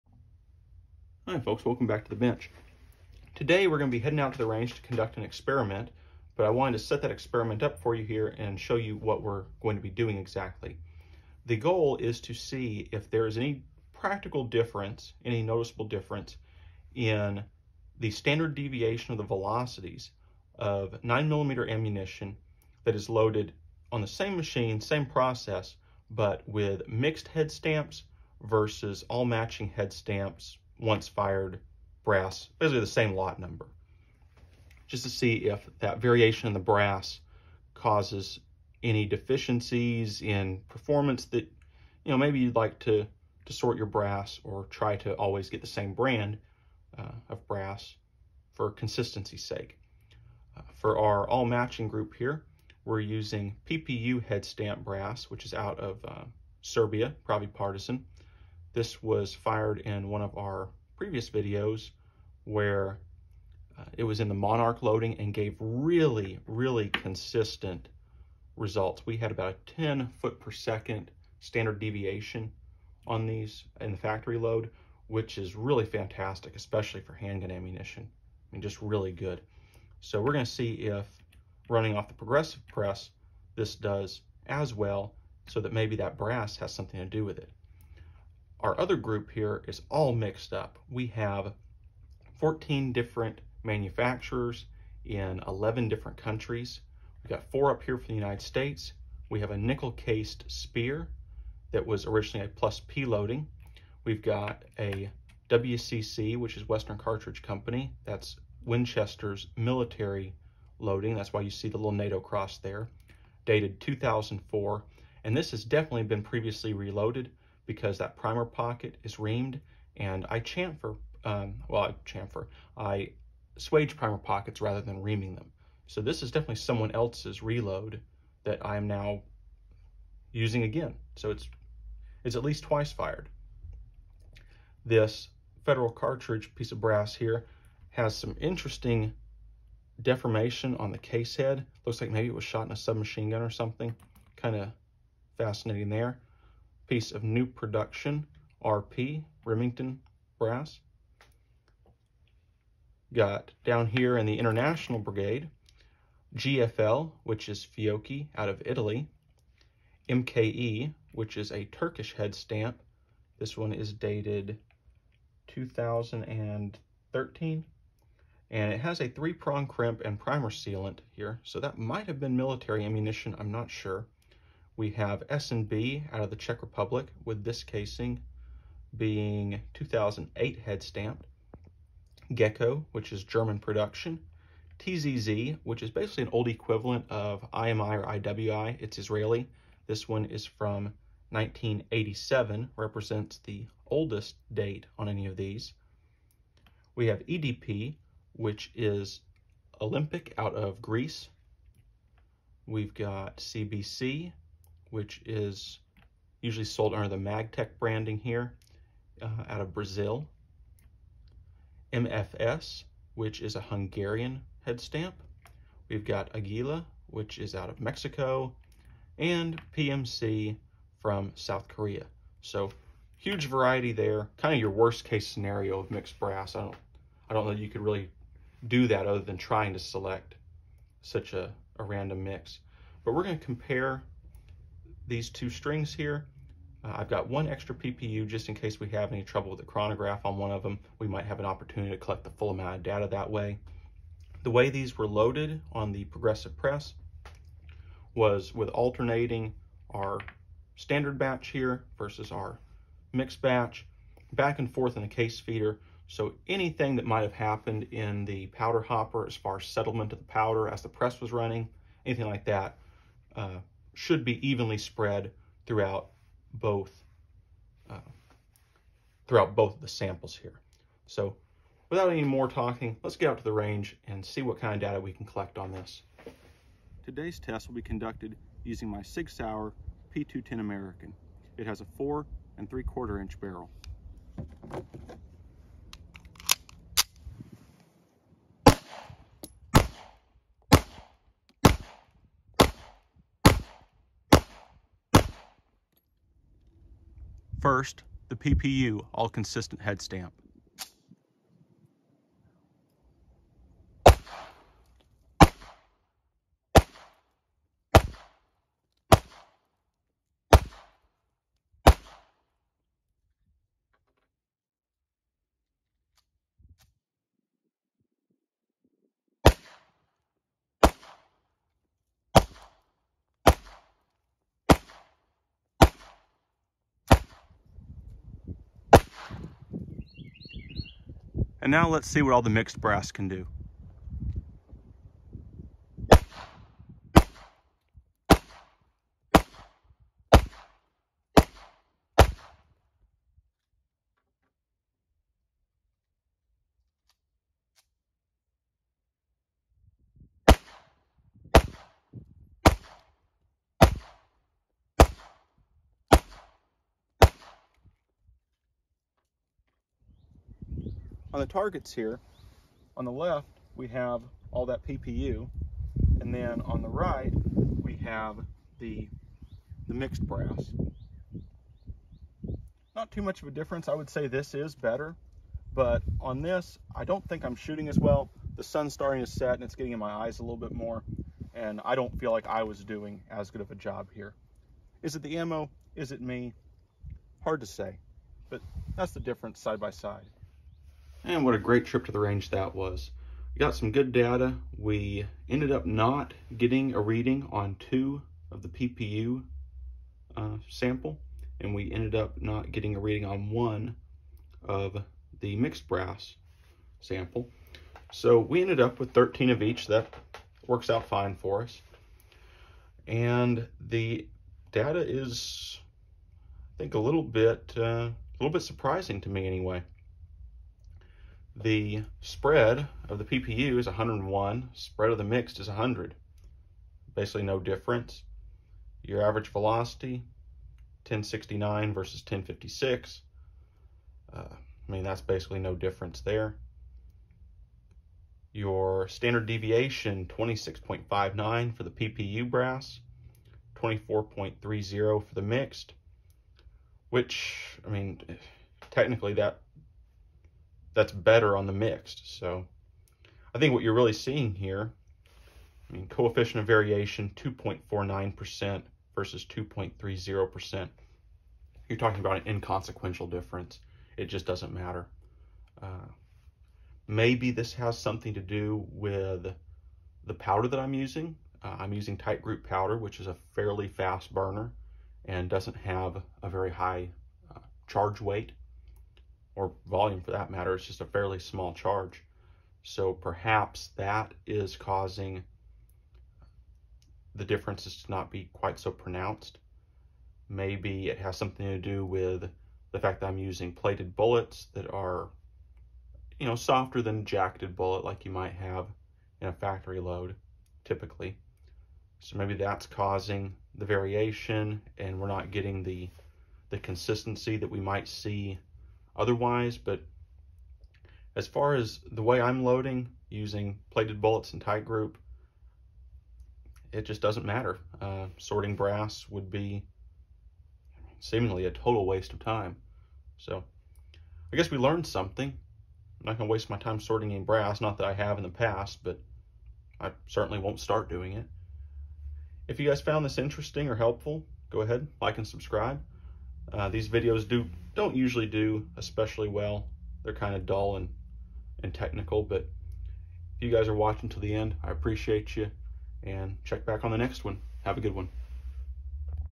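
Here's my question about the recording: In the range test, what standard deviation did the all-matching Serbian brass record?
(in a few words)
26.59.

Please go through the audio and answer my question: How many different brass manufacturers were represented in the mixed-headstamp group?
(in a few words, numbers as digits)
14.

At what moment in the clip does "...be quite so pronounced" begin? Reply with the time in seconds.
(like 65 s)
488 s.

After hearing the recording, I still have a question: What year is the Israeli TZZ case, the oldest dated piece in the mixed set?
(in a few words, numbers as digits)
1987.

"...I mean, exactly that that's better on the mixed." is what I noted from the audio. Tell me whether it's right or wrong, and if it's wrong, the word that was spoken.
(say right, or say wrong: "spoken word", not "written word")
wrong: "technically", not "exactly".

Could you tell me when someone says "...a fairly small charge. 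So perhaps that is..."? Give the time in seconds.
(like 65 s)
481 s.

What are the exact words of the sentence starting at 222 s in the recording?
So huge variety there, kind of your worst case scenario of mixed brass.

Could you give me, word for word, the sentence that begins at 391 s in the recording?
And what a great trip to the range that was.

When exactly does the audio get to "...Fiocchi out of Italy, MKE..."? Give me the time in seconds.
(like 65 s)
157 s.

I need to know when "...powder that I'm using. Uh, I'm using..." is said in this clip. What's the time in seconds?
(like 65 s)
470 s.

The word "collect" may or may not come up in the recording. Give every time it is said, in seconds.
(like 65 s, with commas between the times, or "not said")
241 s, 275 s.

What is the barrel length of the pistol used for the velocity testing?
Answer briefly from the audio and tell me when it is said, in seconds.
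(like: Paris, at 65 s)
4 3/4 inches, at 281 s.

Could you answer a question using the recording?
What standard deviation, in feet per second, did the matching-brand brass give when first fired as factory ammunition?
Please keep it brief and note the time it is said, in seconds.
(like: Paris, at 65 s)
10, at 69 s.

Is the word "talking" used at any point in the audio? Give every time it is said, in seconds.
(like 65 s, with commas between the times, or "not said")
272 s, 461 s.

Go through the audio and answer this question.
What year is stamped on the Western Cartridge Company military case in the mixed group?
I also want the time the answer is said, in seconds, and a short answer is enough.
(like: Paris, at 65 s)
2004, at 113 s.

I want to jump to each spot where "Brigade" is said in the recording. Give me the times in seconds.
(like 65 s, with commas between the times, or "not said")
154 s.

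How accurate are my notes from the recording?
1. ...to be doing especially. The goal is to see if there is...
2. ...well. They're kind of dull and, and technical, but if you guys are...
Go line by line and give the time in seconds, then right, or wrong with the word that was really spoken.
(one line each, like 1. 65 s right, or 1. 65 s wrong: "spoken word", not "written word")
1. 9 s wrong: "exactly", not "especially"
2. 539 s right.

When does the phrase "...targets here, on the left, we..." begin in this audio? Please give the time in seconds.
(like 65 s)
361 s.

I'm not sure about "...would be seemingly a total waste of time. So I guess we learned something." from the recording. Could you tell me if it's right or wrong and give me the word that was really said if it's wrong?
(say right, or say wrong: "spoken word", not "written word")
right.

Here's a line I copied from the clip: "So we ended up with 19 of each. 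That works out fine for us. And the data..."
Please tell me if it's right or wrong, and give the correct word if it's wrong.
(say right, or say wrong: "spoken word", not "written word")
wrong: "13", not "19".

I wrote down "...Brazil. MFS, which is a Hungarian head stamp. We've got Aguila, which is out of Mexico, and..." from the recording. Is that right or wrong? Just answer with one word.
right.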